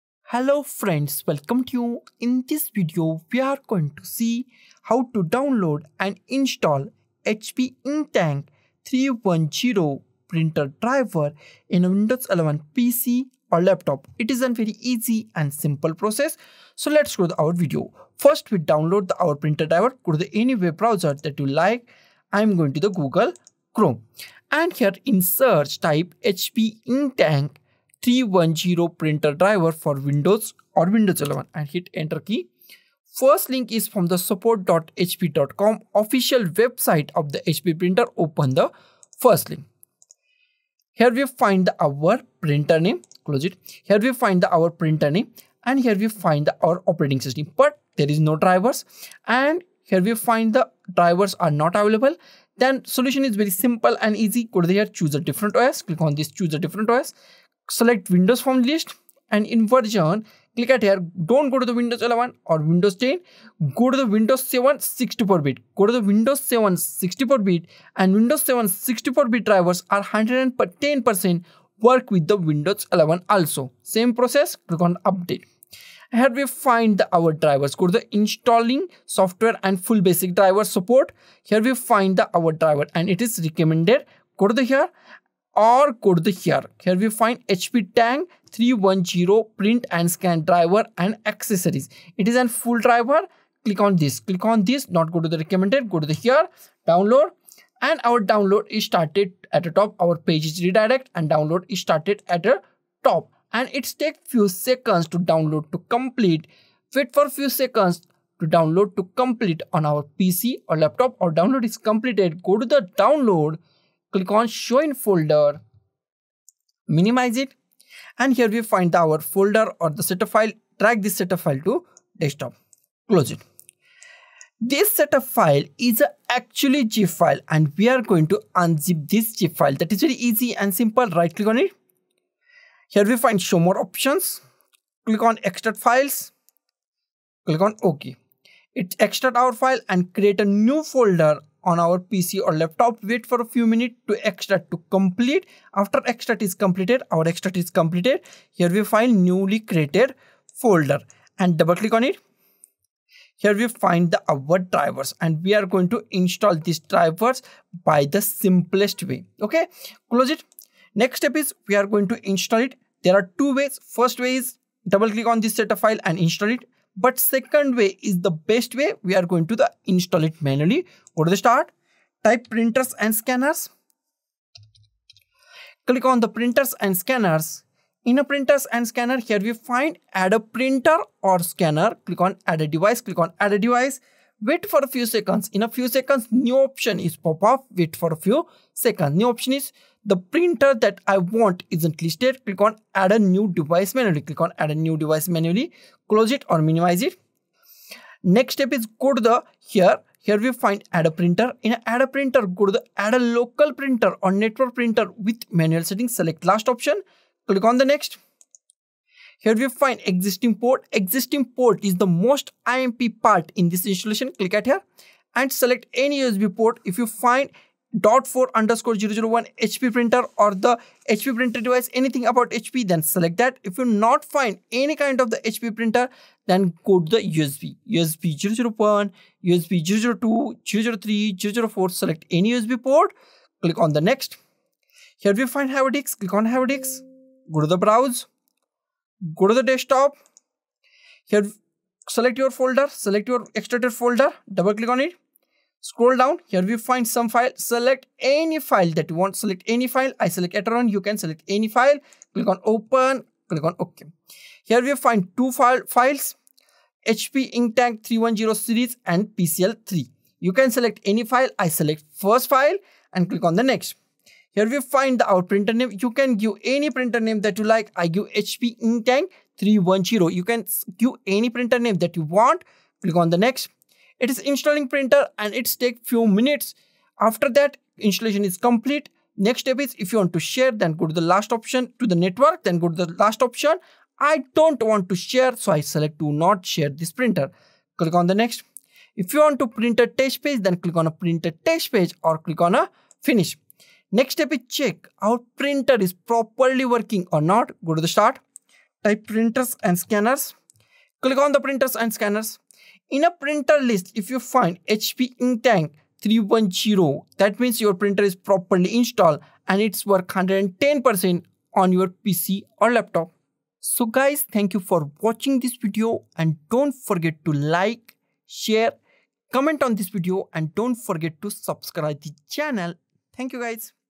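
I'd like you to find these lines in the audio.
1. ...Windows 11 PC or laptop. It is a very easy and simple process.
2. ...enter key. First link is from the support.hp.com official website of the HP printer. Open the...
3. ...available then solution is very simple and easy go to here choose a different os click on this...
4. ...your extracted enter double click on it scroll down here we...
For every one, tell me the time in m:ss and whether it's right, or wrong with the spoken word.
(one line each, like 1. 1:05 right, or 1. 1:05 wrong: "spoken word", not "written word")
1. 0:11 right
2. 0:31 right
3. 0:51 right
4. 4:03 wrong: "folder", not "enter".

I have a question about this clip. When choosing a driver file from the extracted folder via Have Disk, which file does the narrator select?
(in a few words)
Etheron.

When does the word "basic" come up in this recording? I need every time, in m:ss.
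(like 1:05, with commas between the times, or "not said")
1:20.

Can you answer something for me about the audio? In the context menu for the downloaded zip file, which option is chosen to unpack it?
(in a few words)
Extract files.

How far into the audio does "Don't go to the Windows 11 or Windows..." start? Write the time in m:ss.
1:01.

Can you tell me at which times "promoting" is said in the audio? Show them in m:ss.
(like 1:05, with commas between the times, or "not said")
not said.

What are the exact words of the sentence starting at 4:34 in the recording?
It is installing printer and it's take few minutes.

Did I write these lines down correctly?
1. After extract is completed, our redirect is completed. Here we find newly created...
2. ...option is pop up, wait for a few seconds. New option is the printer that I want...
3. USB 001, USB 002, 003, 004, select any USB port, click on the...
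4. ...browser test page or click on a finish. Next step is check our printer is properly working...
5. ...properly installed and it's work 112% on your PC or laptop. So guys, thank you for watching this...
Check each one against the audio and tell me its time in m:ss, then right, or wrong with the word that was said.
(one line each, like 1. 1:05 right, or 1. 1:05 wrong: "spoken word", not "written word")
1. 2:25 wrong: "extract", not "redirect"
2. 3:06 right
3. 3:47 right
4. 4:51 wrong: "printer", not "browser"
5. 5:08 wrong: "110", not "112".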